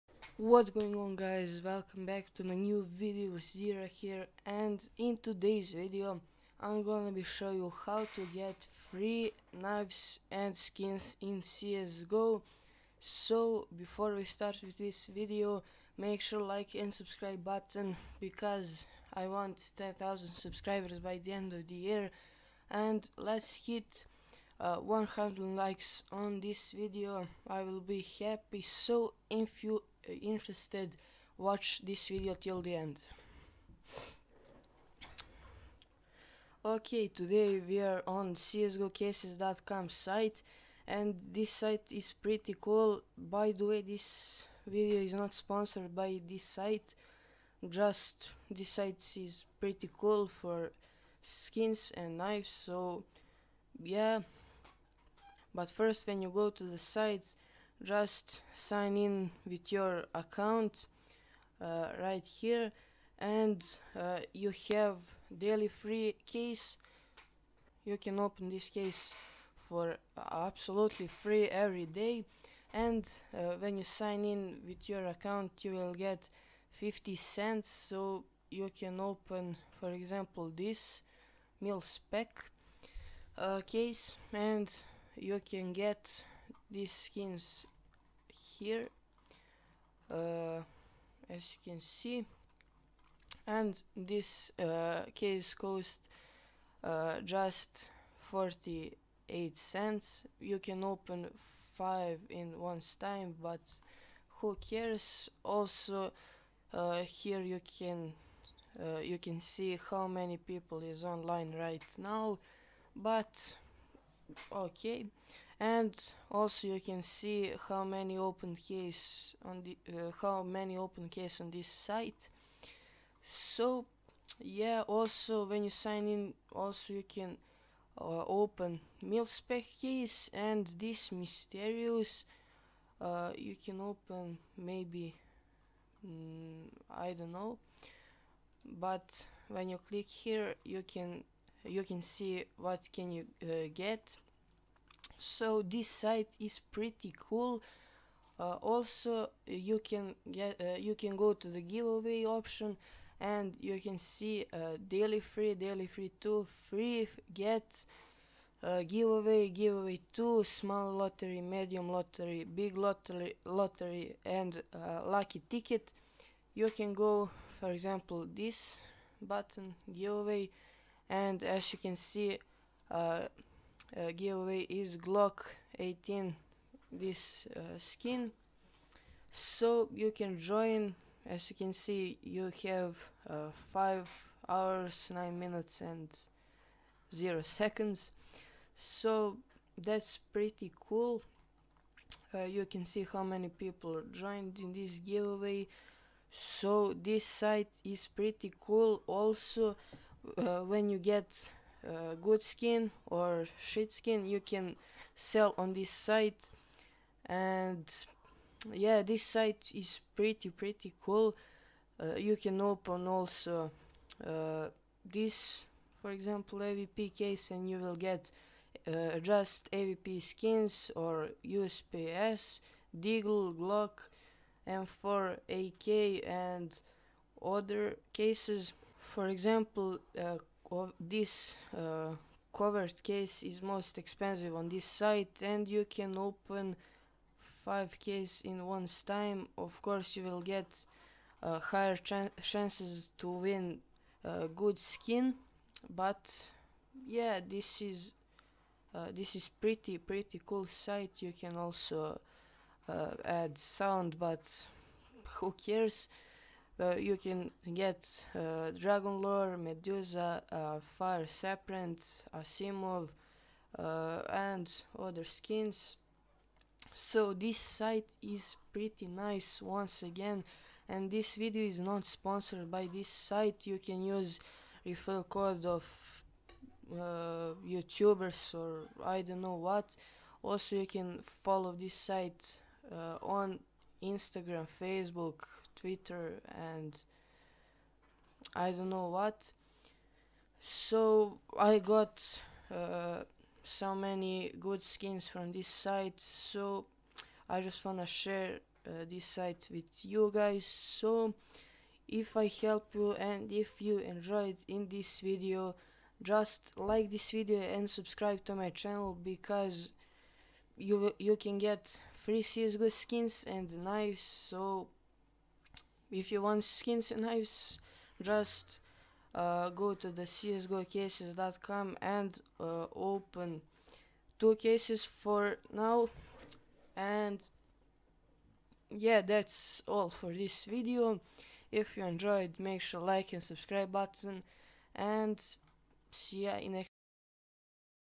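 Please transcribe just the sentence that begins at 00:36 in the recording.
Okay, today we are on csgocases.com site and this site is pretty cool.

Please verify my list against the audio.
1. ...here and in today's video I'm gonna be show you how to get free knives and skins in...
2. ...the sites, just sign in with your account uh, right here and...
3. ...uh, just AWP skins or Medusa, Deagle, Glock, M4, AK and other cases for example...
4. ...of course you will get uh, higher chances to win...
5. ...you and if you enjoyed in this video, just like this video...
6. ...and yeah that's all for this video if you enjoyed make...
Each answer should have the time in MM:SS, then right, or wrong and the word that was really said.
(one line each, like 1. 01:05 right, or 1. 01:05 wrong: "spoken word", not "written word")
1. 00:03 right
2. 00:56 right
3. 03:38 wrong: "USPS", not "Medusa"
4. 03:59 right
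5. 05:02 right
6. 05:26 right.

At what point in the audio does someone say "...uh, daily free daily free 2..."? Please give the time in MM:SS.
02:34.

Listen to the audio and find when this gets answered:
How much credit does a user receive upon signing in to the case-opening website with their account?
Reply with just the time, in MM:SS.
01:16.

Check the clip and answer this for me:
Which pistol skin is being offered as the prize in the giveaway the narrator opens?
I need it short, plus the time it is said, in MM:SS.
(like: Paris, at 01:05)
Glock 18, at 02:54.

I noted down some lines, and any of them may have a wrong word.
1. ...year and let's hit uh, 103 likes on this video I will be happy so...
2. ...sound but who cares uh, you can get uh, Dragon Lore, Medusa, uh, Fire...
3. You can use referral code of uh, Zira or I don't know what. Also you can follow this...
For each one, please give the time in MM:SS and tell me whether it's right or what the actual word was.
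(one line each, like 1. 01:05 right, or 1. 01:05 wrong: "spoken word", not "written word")
1. 00:21 wrong: "100", not "103"
2. 04:13 right
3. 04:33 wrong: "YouTubers", not "Zira".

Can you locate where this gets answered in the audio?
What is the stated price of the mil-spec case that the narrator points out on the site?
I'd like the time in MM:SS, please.
01:38.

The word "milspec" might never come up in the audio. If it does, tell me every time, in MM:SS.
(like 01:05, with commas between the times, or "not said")
02:09.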